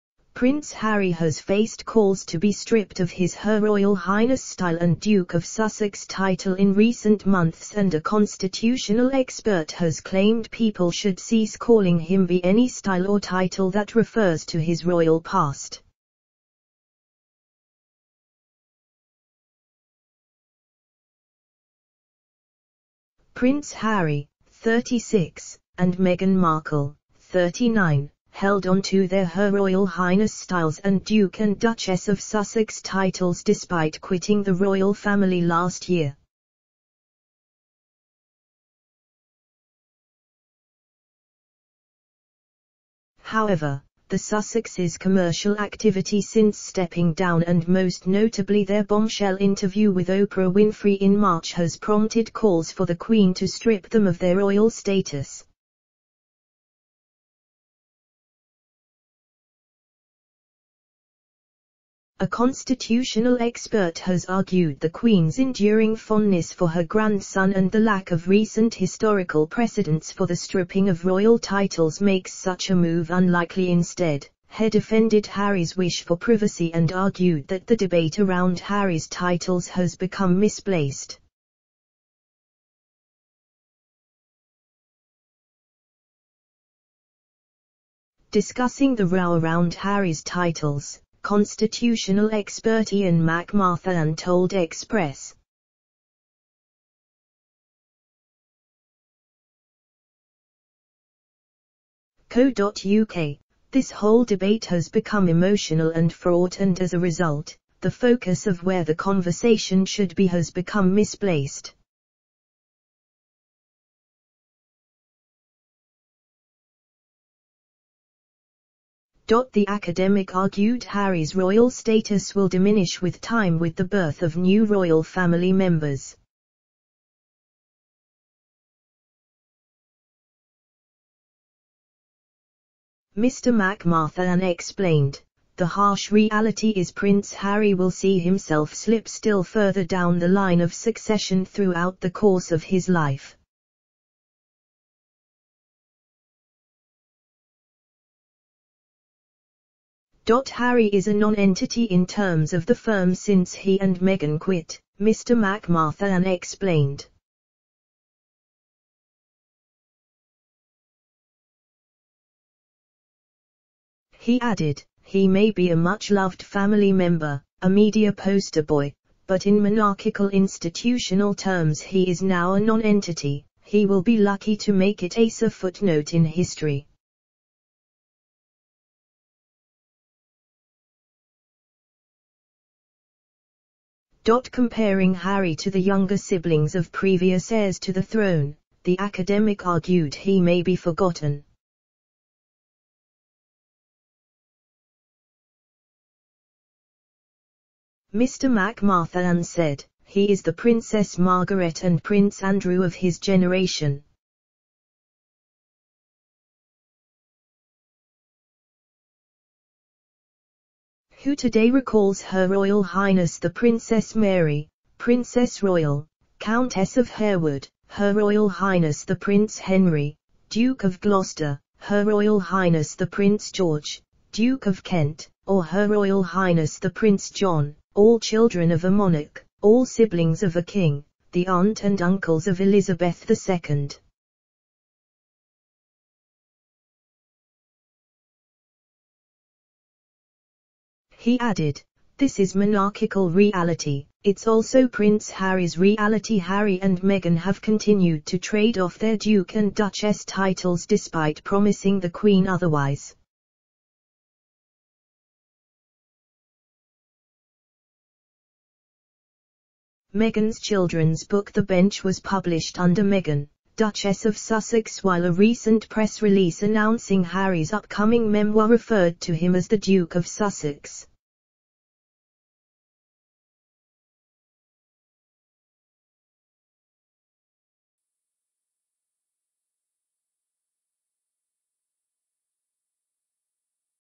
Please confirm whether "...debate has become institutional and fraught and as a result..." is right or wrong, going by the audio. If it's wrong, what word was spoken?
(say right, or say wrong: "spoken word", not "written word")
wrong: "emotional", not "institutional".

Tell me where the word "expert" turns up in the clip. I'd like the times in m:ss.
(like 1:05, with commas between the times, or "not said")
0:09, 1:03, 1:32.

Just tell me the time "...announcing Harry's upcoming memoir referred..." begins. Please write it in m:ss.
4:26.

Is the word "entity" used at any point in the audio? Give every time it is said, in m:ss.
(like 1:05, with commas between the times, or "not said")
2:31, 2:52.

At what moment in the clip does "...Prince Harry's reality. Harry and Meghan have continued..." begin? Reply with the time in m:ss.
4:04.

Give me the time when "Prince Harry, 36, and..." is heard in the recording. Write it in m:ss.
0:23.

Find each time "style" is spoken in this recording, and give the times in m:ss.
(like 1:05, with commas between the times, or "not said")
0:04, 0:12, 0:30.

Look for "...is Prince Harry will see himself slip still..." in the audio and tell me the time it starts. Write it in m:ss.
2:16.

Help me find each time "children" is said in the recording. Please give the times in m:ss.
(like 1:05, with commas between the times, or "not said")
3:48, 4:20.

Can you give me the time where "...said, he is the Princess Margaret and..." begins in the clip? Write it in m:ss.
3:19.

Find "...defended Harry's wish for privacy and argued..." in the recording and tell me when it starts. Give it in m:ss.
1:14.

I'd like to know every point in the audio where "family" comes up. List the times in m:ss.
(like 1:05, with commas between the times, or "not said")
0:34, 2:05, 2:46.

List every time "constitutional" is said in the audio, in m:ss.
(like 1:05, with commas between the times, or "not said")
0:08, 1:02, 1:31.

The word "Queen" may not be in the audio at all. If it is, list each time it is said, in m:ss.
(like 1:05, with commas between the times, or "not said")
0:52, 1:04, 4:12.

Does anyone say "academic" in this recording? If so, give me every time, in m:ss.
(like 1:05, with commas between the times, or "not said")
1:59, 3:08.